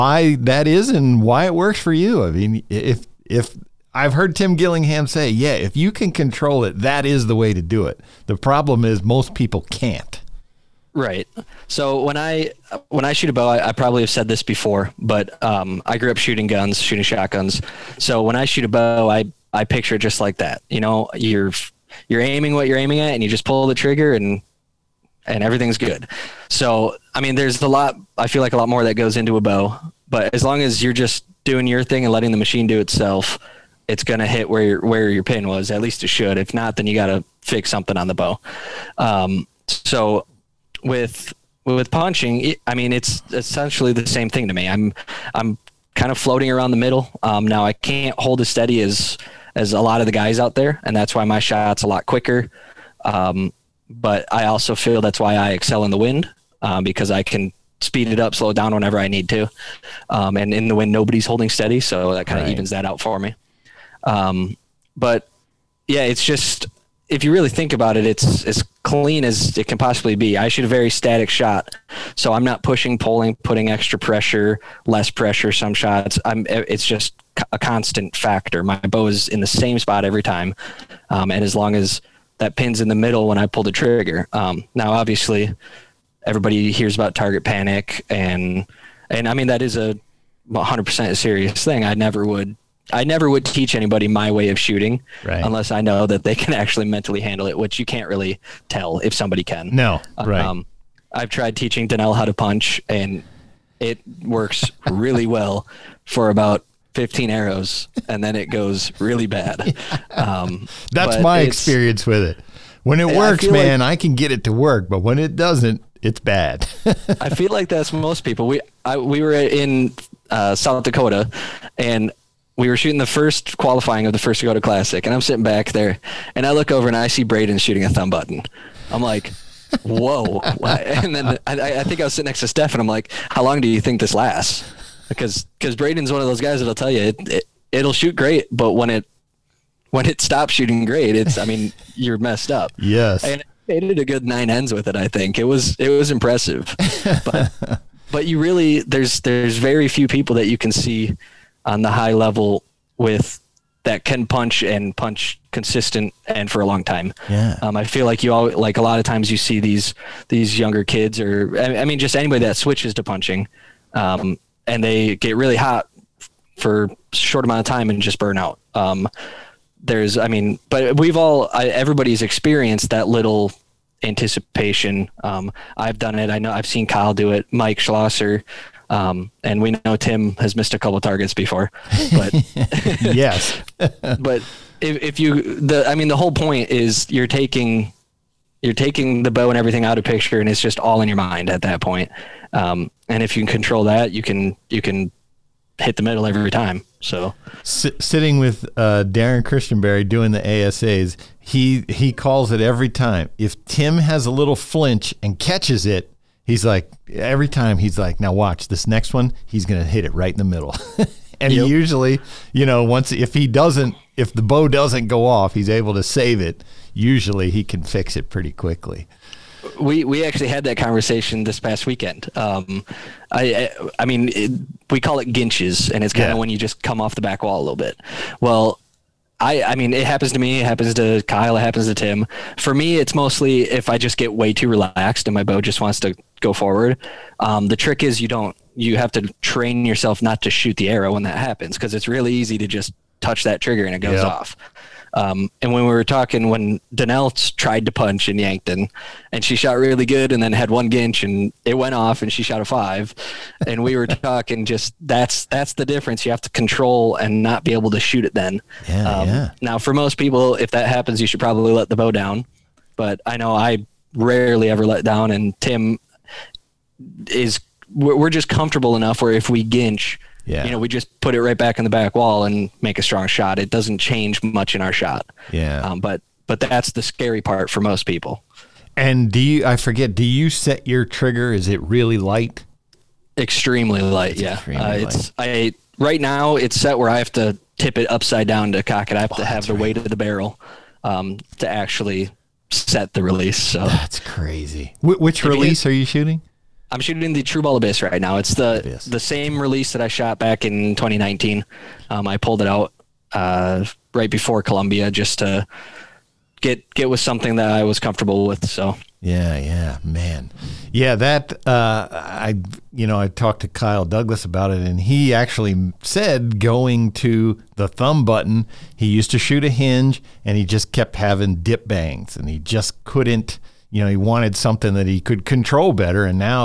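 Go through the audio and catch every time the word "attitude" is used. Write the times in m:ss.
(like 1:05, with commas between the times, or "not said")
not said.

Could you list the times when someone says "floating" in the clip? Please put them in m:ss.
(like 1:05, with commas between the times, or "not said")
0:46.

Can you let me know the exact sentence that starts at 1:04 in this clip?
Um, but yeah, it's just if you really think about it, it's as clean as it can possibly be.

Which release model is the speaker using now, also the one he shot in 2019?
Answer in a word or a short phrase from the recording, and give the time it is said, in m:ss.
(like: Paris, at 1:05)
Tru Ball Abyss, at 4:57.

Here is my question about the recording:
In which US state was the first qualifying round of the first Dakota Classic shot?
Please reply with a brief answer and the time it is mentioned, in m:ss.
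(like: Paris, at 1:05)
South Dakota, at 2:00.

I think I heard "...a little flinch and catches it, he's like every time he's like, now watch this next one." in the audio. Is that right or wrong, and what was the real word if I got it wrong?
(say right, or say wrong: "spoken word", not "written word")
right.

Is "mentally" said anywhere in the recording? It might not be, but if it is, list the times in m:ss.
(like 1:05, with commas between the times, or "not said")
1:36.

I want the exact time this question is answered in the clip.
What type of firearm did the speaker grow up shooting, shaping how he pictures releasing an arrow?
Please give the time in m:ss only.
0:16.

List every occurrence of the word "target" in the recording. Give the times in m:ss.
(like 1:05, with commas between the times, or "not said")
1:27, 3:00.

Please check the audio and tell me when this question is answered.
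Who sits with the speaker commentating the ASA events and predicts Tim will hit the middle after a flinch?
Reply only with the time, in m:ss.
3:19.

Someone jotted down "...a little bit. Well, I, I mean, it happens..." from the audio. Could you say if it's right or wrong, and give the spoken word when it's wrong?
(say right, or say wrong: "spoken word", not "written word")
right.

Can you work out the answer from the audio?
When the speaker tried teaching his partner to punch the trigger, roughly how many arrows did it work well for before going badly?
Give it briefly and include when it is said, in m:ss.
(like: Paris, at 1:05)
15, at 1:46.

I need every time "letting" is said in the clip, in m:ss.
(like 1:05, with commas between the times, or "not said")
0:32.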